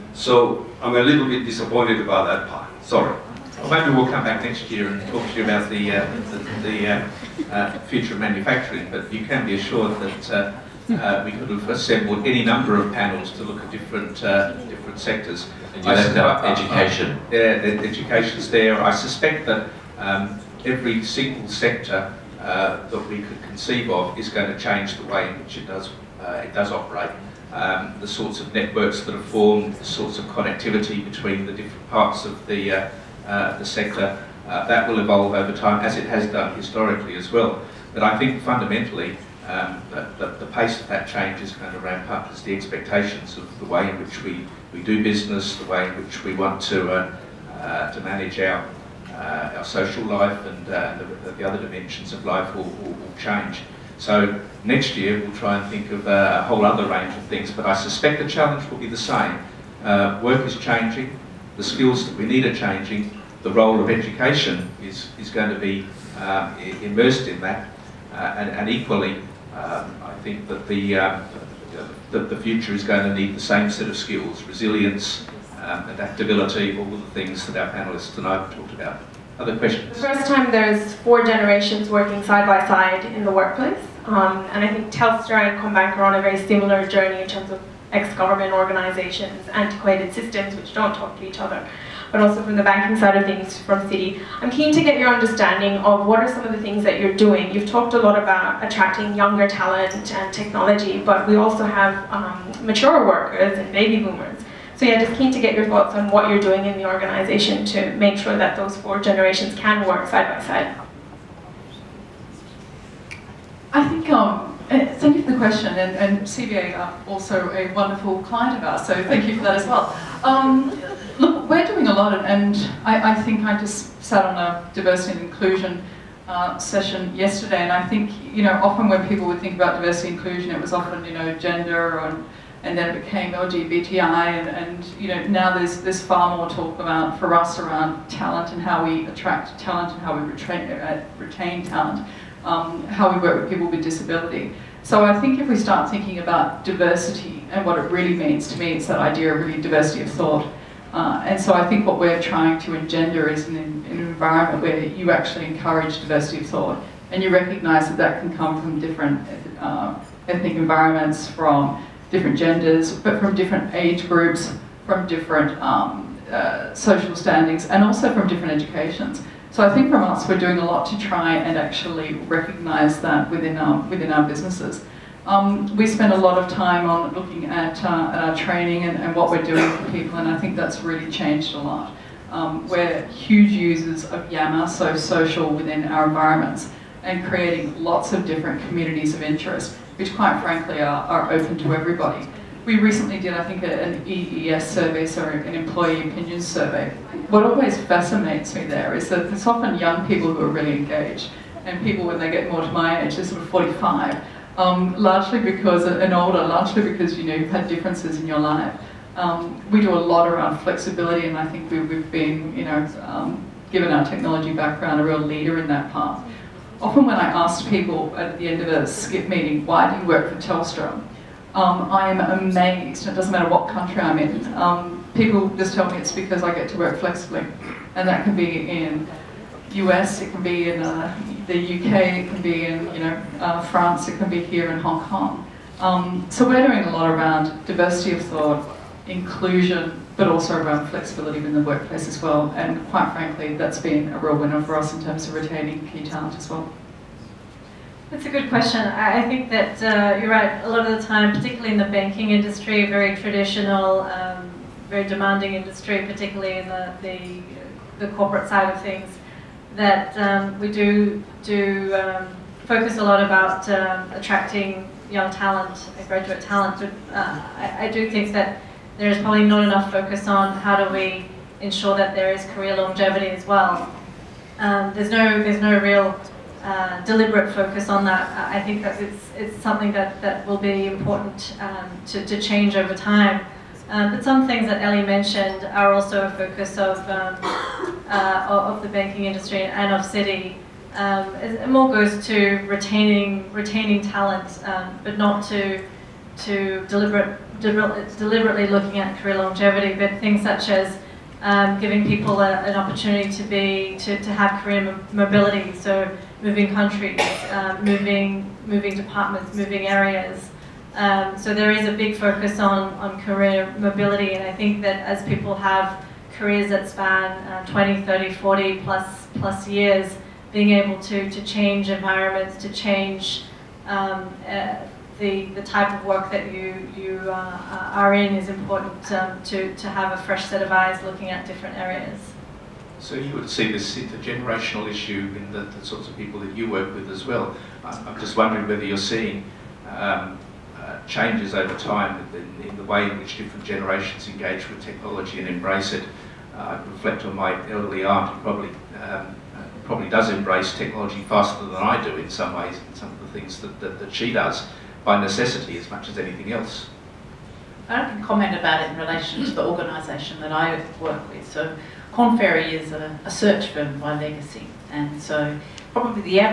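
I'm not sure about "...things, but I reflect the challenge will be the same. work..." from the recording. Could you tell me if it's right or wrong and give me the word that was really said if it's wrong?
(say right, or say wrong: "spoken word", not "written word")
wrong: "suspect", not "reflect".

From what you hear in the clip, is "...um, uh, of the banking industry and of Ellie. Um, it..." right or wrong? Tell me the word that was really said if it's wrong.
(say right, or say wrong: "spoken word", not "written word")
wrong: "Citi", not "Ellie".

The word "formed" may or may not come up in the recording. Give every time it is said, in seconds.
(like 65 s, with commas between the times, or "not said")
29 s.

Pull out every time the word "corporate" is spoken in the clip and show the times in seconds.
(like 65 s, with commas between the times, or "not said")
258 s.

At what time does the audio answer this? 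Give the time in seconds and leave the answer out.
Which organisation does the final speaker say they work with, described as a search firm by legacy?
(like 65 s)
362 s.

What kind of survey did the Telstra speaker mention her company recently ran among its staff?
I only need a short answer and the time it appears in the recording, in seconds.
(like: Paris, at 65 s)
Employee opinion survey, at 195 s.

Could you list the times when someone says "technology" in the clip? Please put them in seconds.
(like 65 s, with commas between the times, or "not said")
100 s, 214 s, 344 s, 350 s.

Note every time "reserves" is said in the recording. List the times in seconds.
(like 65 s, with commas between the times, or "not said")
not said.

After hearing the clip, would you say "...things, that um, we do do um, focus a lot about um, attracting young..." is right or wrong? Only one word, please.
right.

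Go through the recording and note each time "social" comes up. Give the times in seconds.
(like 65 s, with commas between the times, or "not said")
49 s, 166 s, 184 s.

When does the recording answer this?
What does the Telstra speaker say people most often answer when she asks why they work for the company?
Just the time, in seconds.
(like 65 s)
226 s.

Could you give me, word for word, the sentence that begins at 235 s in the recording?
Um, so we're doing a lot around diversity of thought, inclusion, but also around flexibility within the workplace as well.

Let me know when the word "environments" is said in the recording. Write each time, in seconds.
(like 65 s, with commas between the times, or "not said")
153 s, 160 s, 186 s, 321 s.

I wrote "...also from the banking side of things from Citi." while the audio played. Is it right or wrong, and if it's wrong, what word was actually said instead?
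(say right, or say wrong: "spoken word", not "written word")
right.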